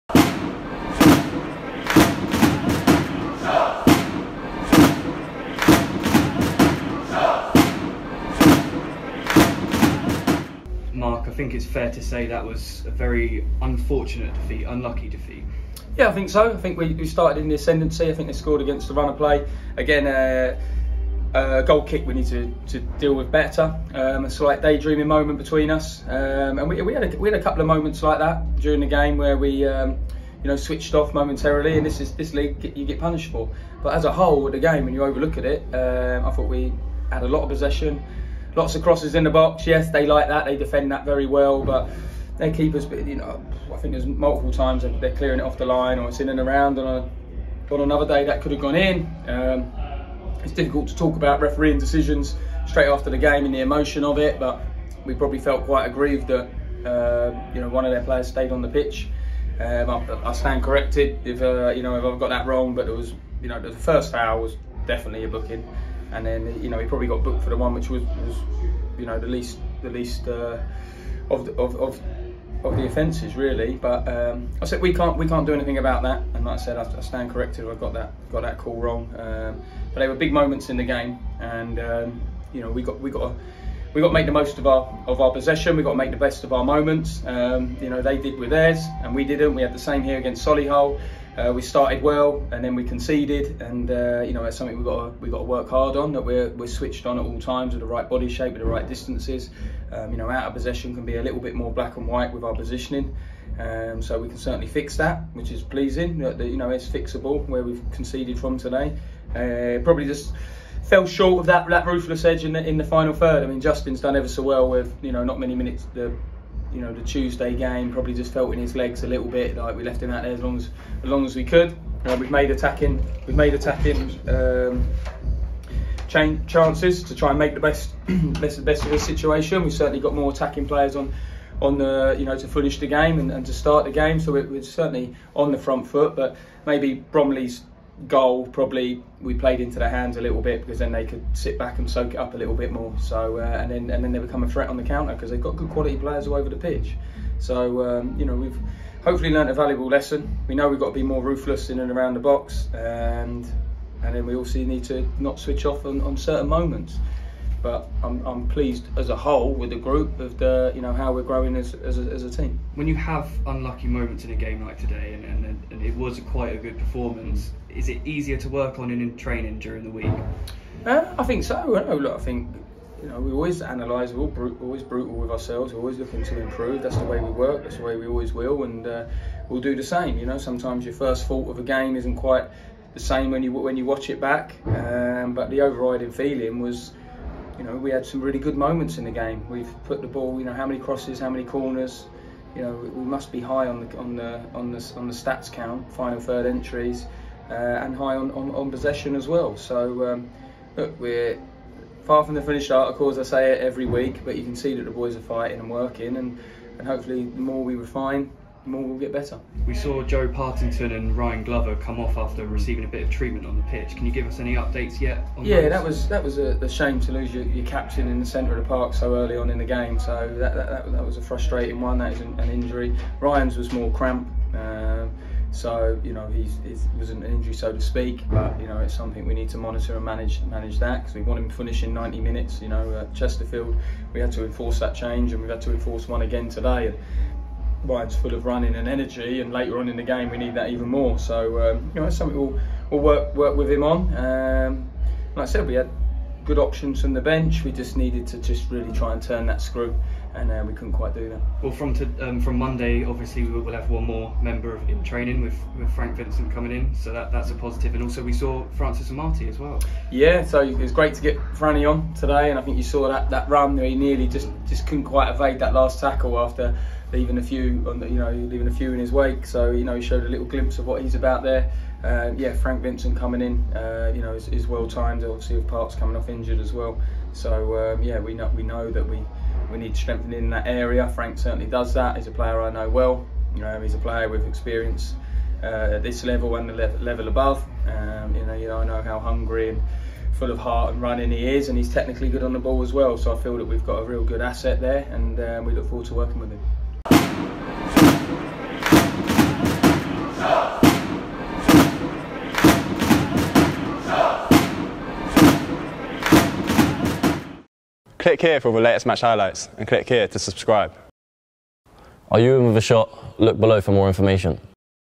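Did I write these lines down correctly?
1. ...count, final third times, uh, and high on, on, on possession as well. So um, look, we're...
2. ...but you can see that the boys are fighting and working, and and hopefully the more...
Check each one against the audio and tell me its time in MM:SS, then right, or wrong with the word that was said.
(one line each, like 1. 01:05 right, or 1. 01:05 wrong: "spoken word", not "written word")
1. 03:15 wrong: "entries", not "times"
2. 03:24 right.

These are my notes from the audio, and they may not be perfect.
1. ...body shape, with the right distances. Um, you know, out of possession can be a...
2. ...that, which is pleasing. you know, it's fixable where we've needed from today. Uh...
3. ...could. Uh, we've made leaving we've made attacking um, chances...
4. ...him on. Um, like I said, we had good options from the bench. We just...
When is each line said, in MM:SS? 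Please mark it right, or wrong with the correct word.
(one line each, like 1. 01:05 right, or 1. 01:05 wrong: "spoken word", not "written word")
1. 01:38 right
2. 01:44 wrong: "conceded", not "needed"
3. 02:01 wrong: "attacking", not "leaving"
4. 04:03 right.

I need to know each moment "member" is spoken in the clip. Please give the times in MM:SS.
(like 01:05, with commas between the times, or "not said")
04:14.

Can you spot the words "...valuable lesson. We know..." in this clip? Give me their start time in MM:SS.
02:29.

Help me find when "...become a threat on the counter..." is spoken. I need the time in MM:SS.
02:24.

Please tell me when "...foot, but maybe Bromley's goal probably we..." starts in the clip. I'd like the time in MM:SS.
02:15.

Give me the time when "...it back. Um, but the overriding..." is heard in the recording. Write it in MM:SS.
03:04.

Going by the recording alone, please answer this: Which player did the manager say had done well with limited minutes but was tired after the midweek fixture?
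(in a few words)
Justin.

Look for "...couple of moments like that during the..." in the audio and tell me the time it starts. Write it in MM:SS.
00:27.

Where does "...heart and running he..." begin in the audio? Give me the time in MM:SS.
04:50.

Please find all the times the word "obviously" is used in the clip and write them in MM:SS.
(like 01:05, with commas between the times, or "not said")
04:13, 04:35.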